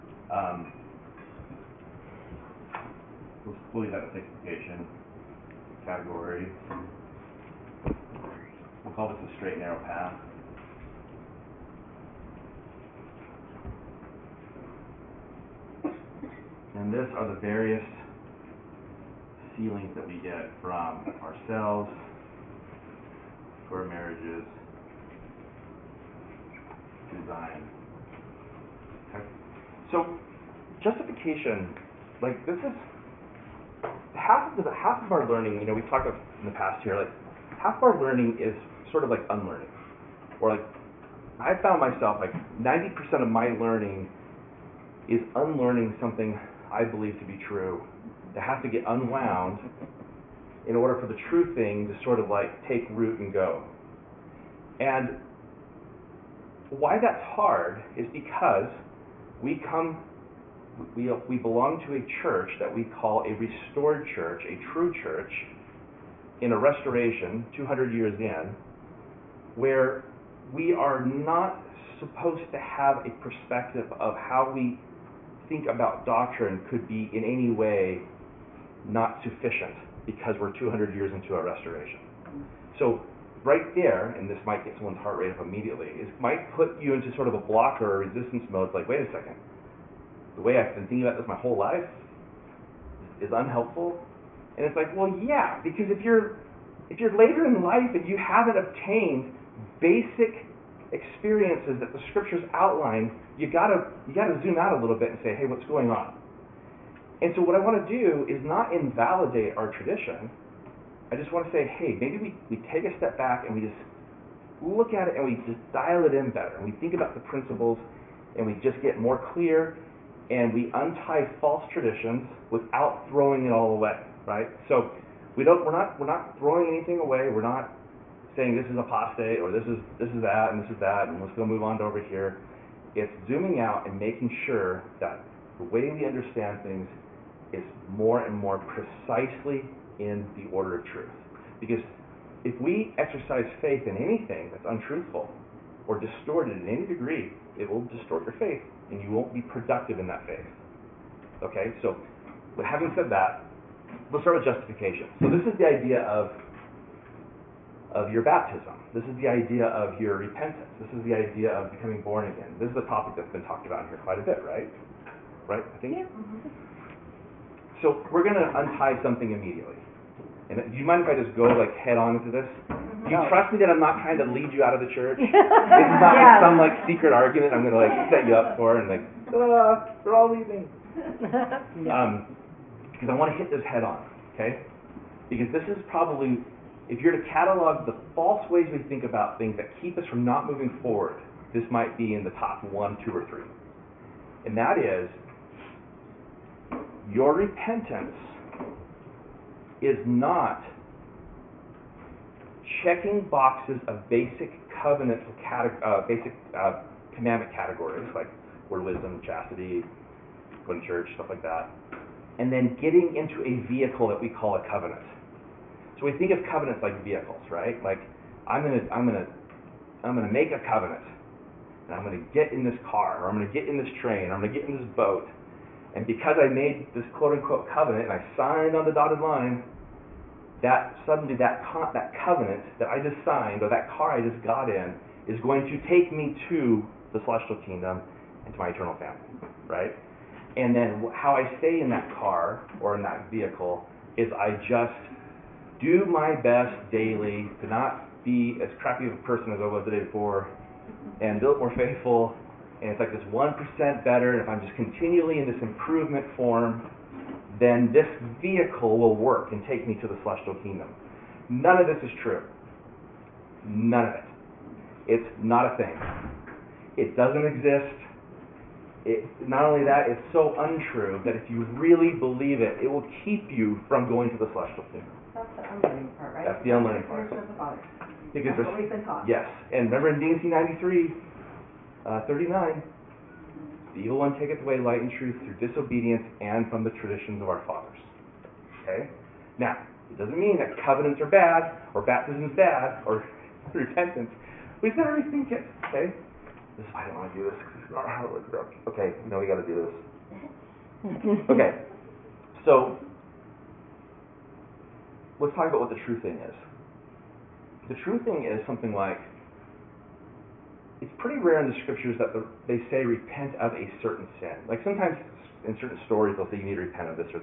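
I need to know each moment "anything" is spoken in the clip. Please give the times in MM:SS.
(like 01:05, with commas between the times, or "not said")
02:06, 02:23.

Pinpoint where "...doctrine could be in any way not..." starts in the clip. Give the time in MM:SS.
01:16.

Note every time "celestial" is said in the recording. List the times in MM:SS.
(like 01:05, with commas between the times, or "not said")
03:57, 04:20, 04:34.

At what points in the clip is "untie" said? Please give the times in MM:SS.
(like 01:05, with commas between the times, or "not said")
02:00, 02:48.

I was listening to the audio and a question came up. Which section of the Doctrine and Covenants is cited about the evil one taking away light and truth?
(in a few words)
D&C 93.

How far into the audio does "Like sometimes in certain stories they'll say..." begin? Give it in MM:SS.
05:14.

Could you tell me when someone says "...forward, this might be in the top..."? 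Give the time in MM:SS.
03:10.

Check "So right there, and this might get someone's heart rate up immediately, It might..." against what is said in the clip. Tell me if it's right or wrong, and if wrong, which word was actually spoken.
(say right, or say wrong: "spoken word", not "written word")
right.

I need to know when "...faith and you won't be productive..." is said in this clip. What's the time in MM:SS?
02:28.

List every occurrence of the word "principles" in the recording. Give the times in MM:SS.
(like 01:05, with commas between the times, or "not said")
01:57.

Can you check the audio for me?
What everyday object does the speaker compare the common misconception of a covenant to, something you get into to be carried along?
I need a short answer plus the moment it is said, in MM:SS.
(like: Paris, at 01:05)
A vehicle, at 03:37.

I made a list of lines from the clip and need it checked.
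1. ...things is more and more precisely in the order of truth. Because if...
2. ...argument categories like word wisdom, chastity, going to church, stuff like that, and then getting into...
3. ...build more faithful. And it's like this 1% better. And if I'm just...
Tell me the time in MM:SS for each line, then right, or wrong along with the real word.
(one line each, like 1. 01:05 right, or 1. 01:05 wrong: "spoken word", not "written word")
1. 02:16 right
2. 03:27 wrong: "commandment", not "argument"
3. 04:11 right.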